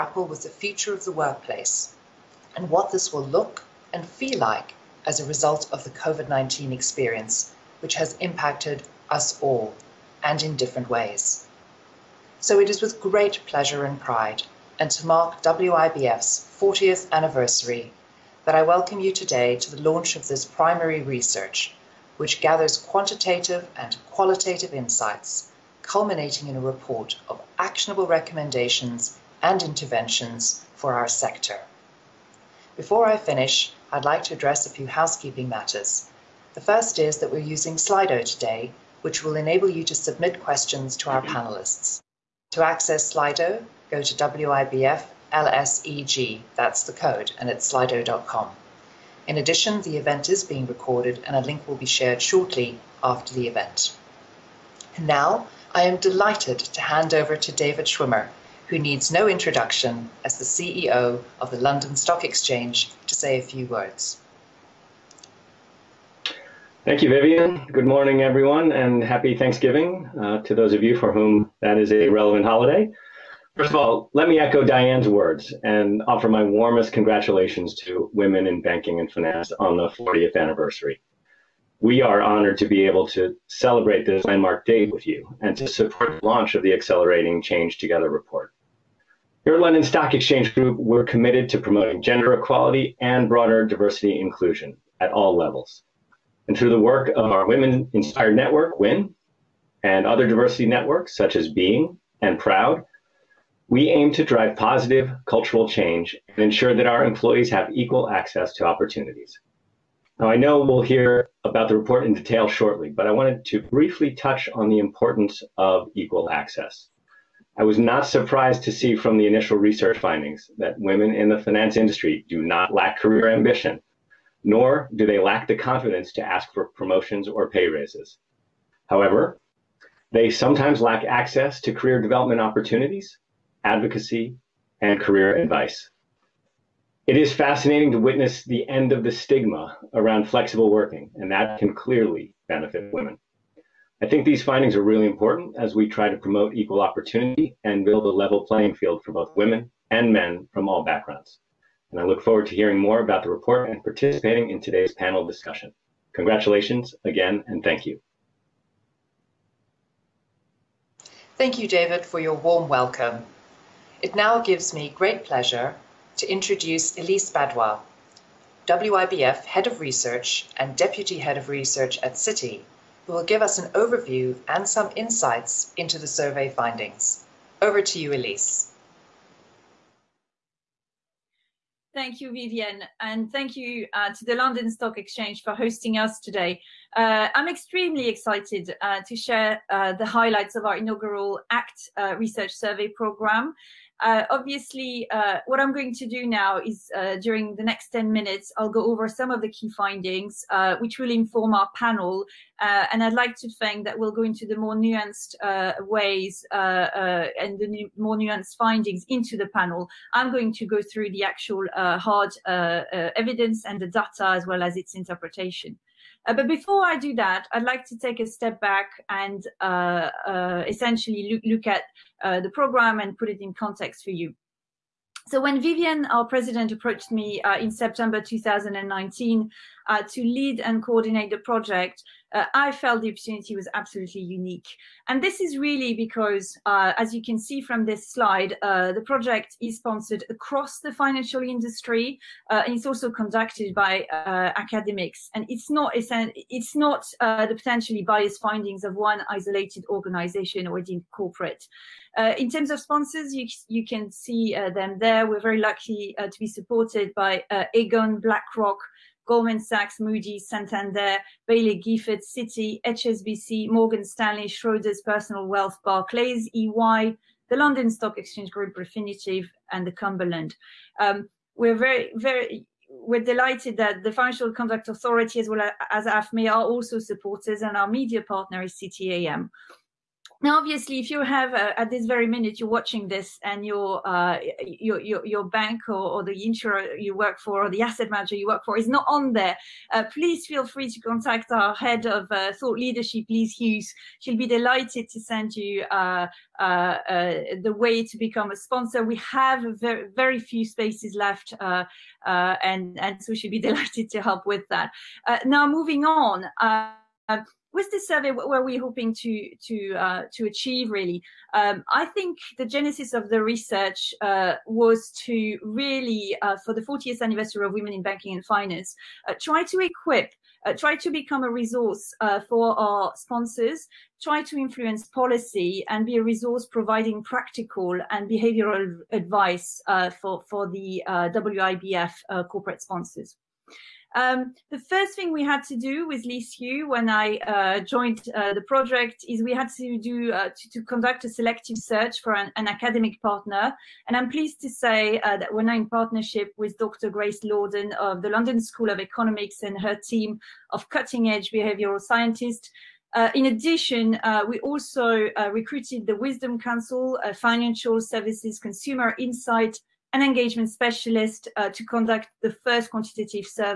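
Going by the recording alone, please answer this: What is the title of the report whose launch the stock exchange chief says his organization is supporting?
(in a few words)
Accelerating Change Together.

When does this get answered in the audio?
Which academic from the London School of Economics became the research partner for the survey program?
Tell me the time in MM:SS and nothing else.
05:46.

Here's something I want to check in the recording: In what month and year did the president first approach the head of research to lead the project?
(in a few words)
September 2019.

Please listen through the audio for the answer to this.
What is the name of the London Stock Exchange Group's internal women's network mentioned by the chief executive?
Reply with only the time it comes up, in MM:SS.
01:37.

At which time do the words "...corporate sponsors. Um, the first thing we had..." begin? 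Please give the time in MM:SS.
05:32.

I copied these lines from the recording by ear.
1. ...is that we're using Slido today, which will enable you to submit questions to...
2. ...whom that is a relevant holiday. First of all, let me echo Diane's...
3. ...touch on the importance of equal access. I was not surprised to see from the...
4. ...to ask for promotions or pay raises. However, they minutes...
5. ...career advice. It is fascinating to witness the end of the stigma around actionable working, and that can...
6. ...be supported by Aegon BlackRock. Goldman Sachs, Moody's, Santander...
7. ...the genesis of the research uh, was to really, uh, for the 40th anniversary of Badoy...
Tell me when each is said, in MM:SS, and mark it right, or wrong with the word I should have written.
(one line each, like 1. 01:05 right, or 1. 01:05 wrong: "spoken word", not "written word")
1. 00:36 right
2. 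01:11 right
3. 01:54 right
4. 02:06 wrong: "sometimes", not "minutes"
5. 02:15 wrong: "flexible", not "actionable"
6. 04:16 right
7. 05:12 wrong: "Women", not "Badoy".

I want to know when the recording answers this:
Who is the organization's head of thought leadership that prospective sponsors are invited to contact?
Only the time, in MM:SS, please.
04:53.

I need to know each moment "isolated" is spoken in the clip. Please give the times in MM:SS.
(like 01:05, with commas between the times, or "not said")
04:09.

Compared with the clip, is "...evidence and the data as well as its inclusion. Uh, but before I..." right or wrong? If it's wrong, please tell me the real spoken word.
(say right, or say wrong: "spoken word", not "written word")
wrong: "interpretation", not "inclusion".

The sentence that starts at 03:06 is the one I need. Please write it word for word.
Uh, I'm extremely excited uh, to share uh, the highlights of our inaugural ACT uh, research survey program.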